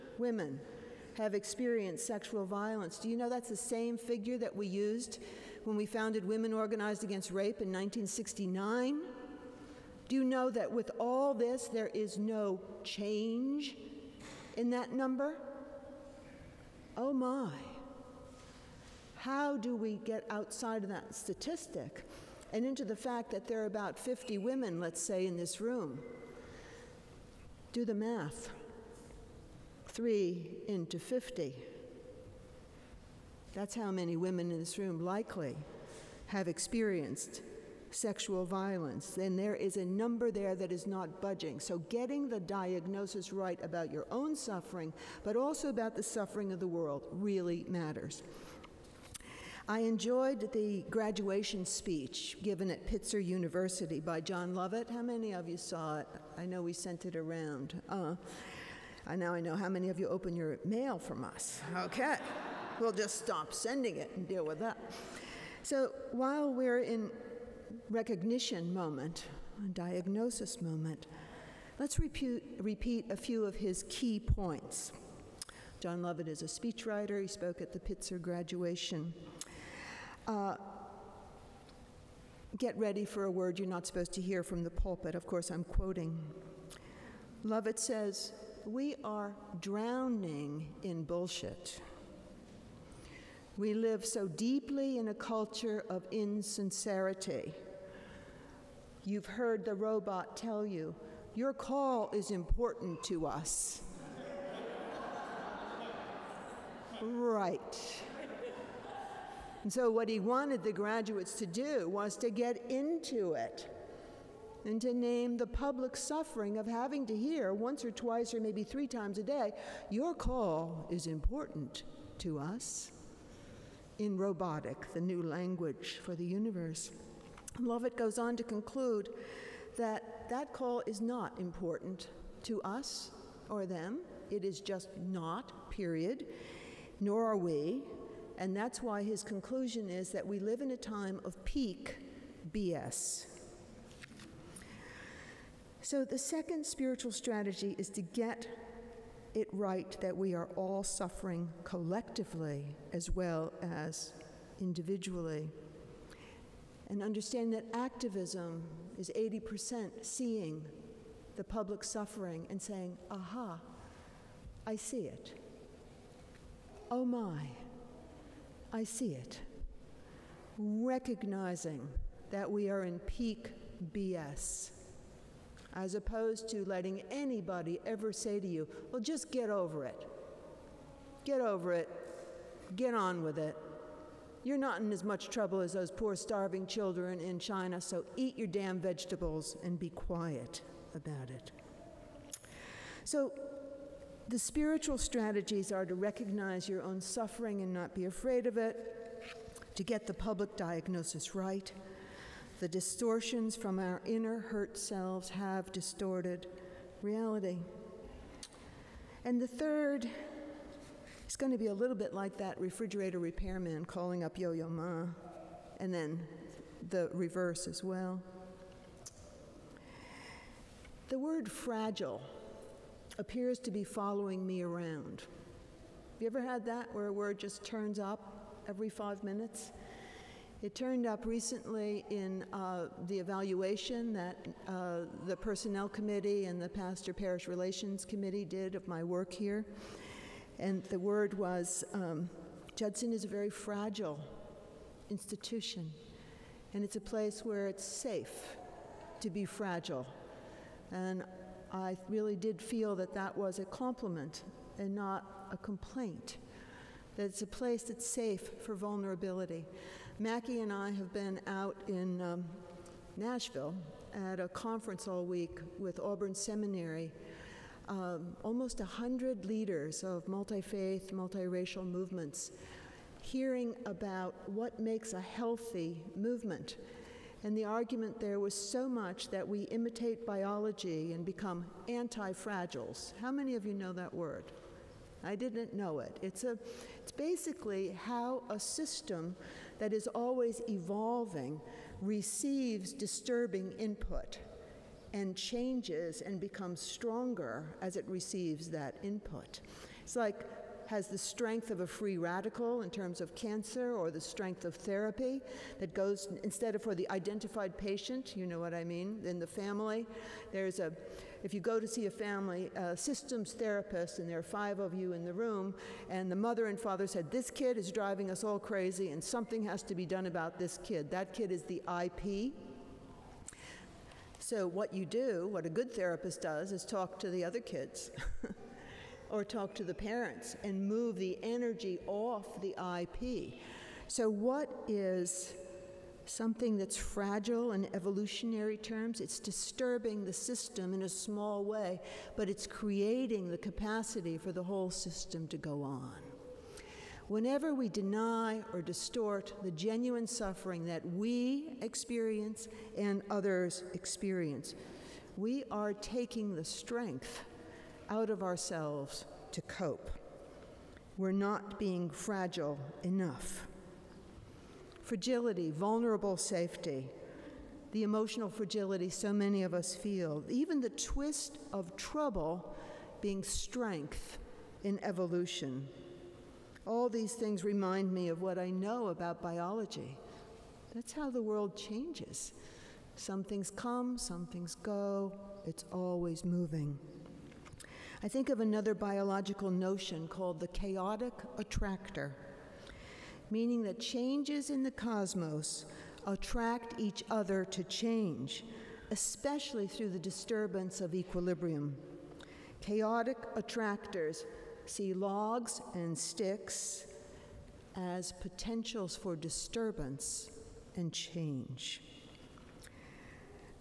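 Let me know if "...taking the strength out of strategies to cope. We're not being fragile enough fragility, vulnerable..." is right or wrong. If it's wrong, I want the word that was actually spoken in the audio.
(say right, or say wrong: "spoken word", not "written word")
wrong: "ourselves", not "strategies".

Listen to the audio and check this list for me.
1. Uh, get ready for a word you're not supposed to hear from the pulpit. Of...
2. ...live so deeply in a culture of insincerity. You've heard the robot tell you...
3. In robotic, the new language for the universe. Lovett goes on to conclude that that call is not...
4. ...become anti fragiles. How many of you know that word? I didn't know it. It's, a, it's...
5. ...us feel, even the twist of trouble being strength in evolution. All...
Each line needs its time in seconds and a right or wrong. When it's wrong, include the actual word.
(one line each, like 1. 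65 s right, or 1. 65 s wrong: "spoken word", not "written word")
1. 80 s right
2. 93 s right
3. 123 s right
4. 281 s right
5. 369 s right.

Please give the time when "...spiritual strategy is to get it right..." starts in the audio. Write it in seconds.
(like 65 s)
146 s.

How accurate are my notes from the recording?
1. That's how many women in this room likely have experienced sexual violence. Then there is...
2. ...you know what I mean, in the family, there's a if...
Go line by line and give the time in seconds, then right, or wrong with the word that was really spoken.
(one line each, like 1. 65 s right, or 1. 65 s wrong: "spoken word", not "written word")
1. 33 s right
2. 308 s right.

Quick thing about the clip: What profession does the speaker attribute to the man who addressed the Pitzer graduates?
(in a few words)
Speechwriter.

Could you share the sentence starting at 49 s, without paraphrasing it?
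I enjoyed the graduation speech given at Pitzer University by Jon Lovett.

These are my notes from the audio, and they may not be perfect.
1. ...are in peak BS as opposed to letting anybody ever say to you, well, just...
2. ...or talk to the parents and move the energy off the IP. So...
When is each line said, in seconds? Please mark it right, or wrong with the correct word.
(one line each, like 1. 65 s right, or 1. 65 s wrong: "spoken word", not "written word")
1. 172 s right
2. 329 s right.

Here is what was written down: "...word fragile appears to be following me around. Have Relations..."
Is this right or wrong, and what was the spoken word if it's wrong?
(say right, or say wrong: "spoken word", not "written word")
wrong: "You", not "Relations".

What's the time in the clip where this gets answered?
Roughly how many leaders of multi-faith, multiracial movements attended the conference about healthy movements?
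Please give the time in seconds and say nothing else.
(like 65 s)
268 s.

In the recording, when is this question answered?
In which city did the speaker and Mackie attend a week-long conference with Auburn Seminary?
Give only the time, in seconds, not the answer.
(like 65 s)
263 s.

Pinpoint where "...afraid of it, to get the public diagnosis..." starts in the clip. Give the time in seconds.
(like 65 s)
198 s.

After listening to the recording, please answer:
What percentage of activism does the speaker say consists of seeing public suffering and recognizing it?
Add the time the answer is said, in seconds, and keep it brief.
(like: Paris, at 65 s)
80%, at 159 s.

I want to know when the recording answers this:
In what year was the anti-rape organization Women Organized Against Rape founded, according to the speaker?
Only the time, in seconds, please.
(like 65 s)
7 s.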